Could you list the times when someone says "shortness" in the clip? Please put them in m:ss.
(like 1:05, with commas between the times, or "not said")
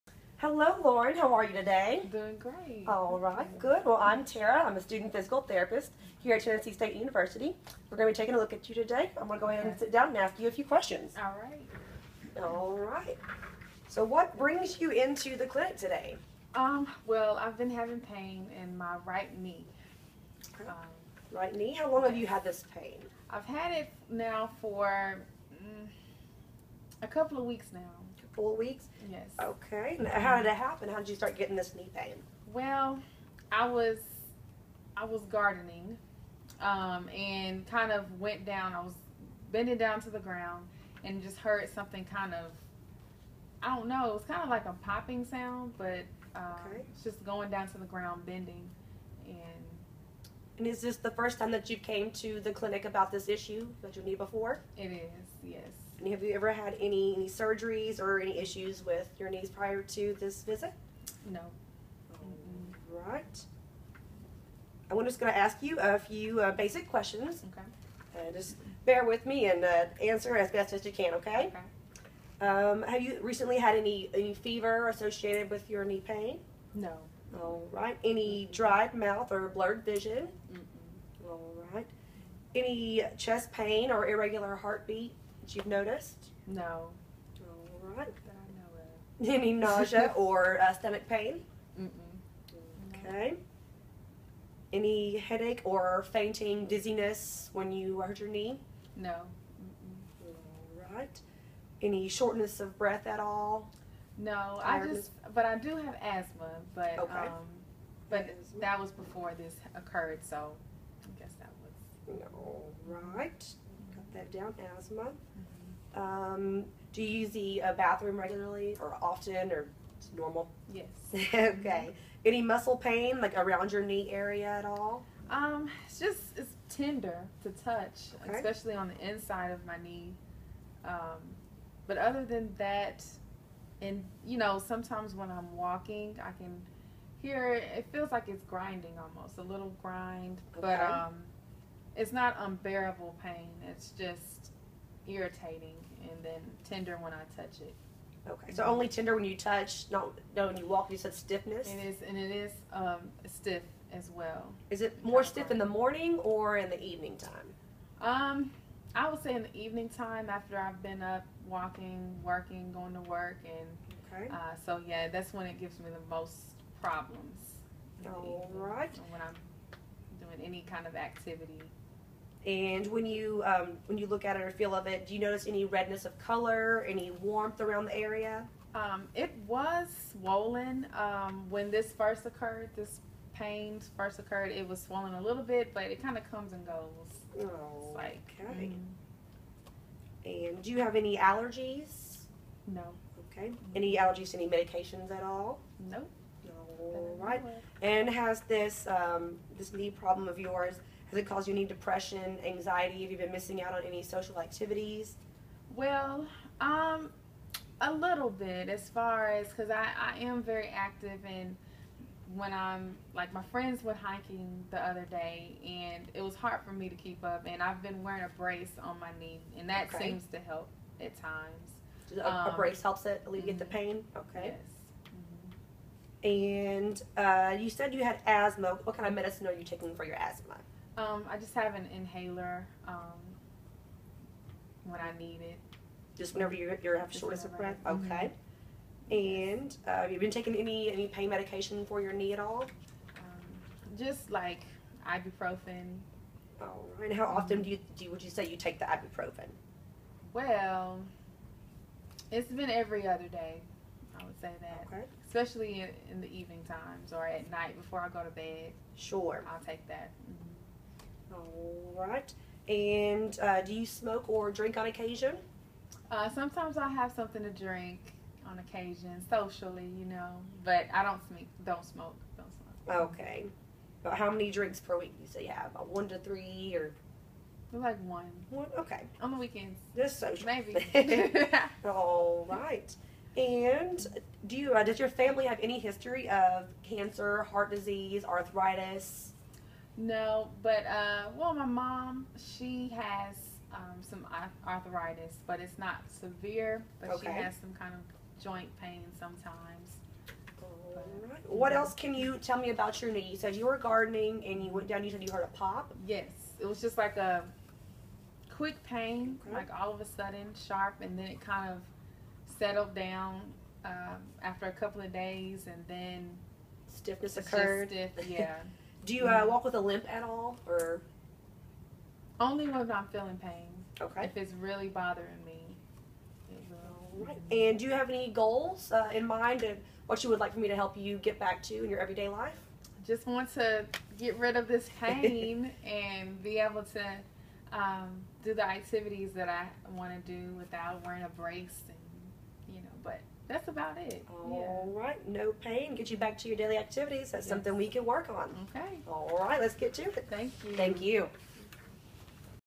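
1:42, 3:57.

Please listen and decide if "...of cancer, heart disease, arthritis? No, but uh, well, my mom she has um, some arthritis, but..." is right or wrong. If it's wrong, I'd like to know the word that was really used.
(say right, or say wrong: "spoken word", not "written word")
right.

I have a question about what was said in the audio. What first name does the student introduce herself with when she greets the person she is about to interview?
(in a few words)
Tara.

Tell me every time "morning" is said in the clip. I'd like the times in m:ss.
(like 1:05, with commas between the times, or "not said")
2:35.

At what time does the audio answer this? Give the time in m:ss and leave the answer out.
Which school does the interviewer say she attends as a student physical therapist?
0:06.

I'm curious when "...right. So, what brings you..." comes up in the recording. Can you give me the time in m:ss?
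0:12.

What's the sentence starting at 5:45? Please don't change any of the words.
Get you back to your daily activities.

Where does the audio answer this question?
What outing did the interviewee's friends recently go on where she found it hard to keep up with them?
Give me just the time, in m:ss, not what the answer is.
3:33.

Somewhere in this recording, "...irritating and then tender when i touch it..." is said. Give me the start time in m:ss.
2:25.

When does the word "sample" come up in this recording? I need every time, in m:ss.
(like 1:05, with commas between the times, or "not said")
not said.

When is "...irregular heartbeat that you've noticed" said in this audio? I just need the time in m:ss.
1:24.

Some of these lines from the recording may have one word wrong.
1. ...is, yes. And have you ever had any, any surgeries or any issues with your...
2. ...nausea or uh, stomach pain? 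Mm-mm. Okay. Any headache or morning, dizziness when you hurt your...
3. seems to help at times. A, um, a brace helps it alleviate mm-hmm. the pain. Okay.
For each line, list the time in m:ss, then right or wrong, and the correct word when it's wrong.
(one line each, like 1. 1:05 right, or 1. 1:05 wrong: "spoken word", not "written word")
1. 0:54 right
2. 1:29 wrong: "fainting", not "morning"
3. 3:40 right.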